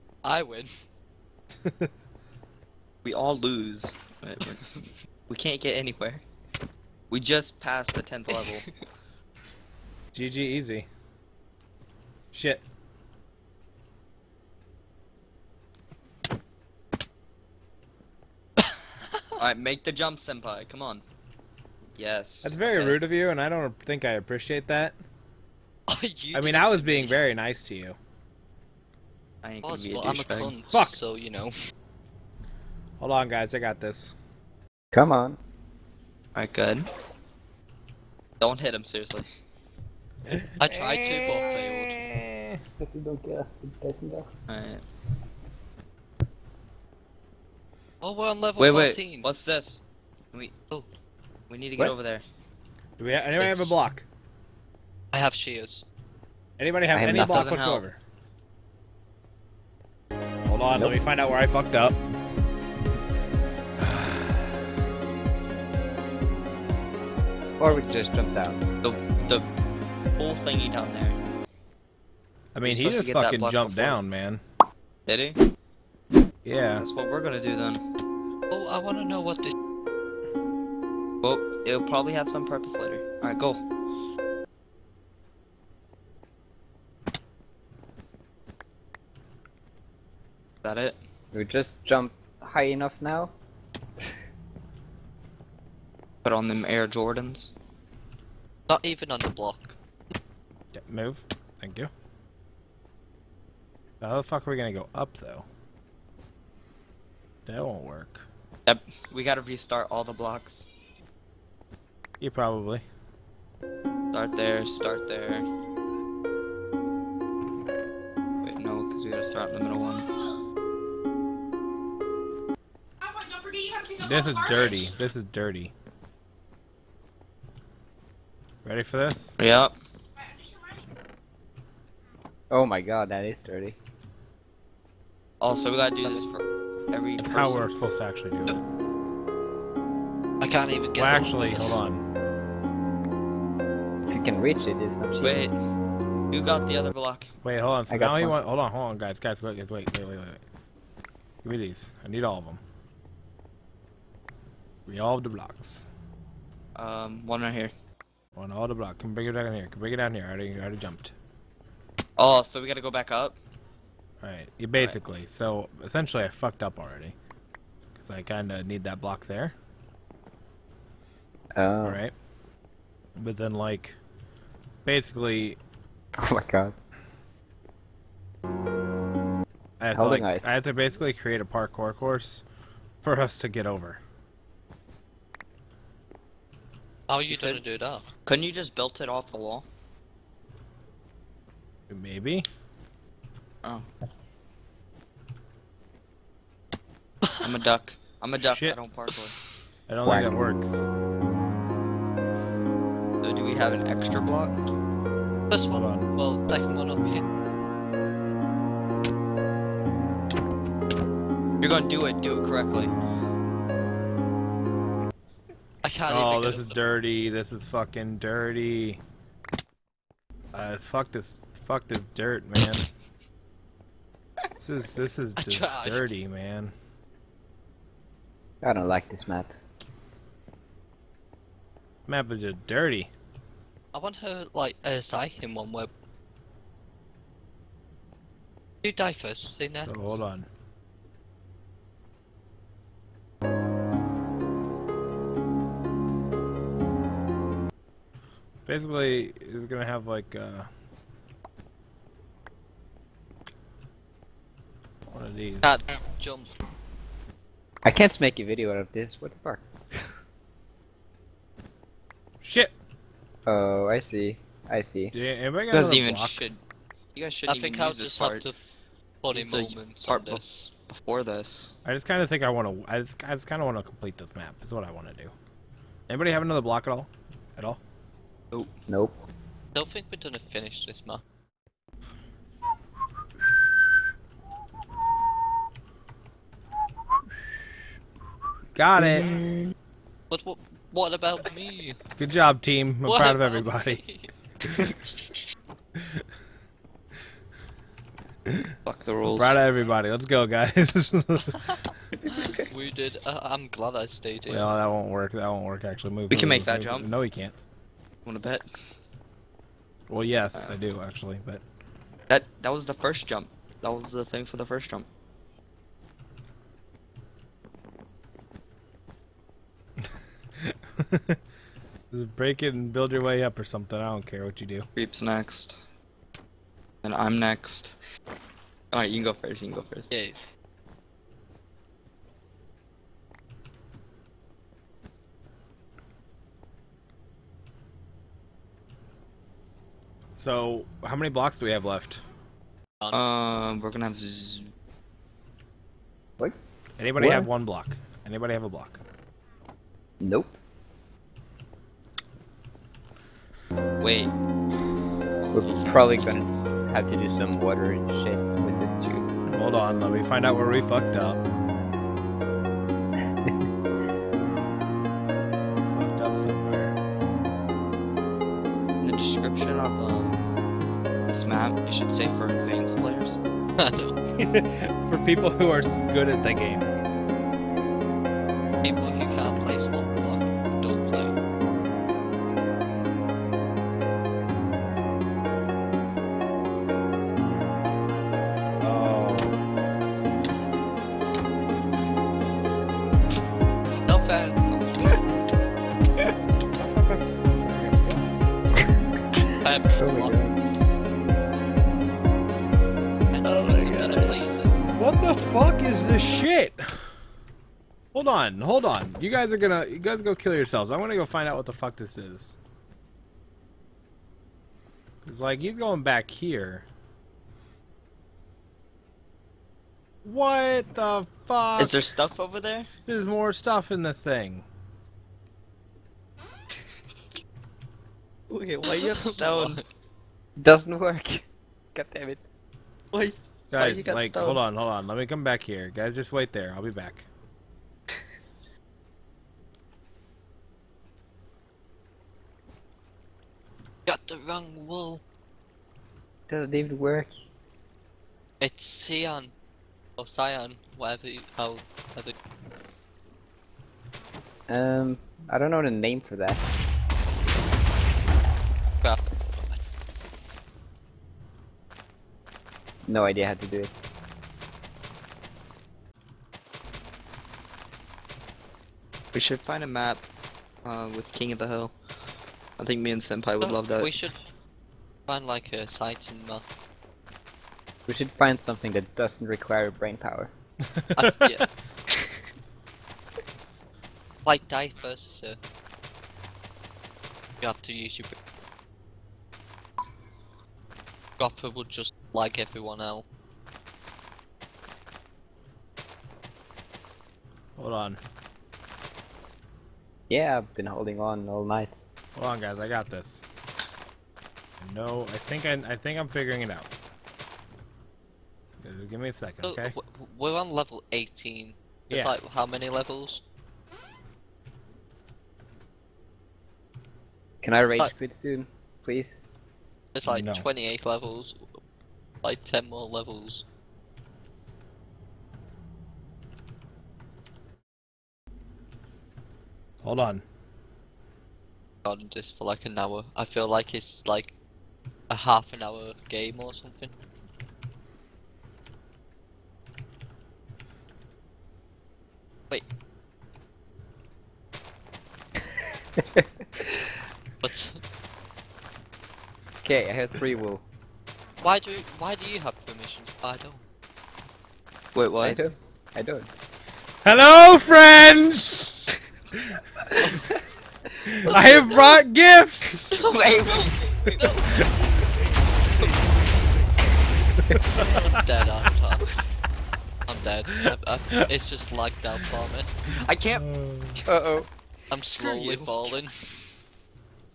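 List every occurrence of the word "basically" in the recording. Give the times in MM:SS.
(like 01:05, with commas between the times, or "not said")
02:44, 02:54, 03:00, 04:08.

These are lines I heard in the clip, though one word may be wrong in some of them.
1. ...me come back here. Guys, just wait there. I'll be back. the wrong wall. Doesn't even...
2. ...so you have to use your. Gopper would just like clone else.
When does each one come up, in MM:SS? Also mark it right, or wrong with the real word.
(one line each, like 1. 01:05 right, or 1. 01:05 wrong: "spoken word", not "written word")
1. 07:15 right
2. 08:05 wrong: "everyone", not "clone".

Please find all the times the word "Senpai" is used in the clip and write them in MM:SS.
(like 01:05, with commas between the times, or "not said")
00:20, 07:53.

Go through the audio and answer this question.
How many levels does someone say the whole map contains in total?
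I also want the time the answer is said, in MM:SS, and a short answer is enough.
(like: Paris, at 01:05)
28, at 08:40.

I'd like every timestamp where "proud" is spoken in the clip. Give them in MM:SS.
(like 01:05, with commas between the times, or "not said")
04:53, 04:59.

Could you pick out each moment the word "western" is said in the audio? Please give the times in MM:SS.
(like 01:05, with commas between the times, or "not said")
not said.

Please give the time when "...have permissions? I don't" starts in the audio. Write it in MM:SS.
09:12.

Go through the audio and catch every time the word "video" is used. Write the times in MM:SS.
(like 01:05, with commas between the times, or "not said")
04:18.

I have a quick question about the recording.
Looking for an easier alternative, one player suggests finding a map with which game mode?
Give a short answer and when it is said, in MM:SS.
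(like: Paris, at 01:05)
King of the Hill, at 07:51.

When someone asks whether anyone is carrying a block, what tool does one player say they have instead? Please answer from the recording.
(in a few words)
Shears.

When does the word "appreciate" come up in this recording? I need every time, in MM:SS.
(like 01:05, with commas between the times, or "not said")
00:24.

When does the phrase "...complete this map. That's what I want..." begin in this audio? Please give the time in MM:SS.
04:33.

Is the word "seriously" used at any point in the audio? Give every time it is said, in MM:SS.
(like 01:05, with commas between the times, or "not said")
00:38.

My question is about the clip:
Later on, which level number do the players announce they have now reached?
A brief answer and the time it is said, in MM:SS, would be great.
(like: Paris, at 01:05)
18, at 08:30.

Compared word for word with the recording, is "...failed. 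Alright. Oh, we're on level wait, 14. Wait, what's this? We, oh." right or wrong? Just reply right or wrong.
right.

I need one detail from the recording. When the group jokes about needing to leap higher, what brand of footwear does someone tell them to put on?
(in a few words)
Air Jordans.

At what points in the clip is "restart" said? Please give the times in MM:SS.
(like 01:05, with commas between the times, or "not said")
01:49.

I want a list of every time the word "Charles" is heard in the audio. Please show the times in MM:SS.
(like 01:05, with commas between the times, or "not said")
not said.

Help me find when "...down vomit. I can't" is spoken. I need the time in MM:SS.
09:32.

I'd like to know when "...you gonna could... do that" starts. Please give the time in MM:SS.
03:07.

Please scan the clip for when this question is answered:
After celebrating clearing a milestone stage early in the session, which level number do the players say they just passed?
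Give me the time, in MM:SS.
00:08.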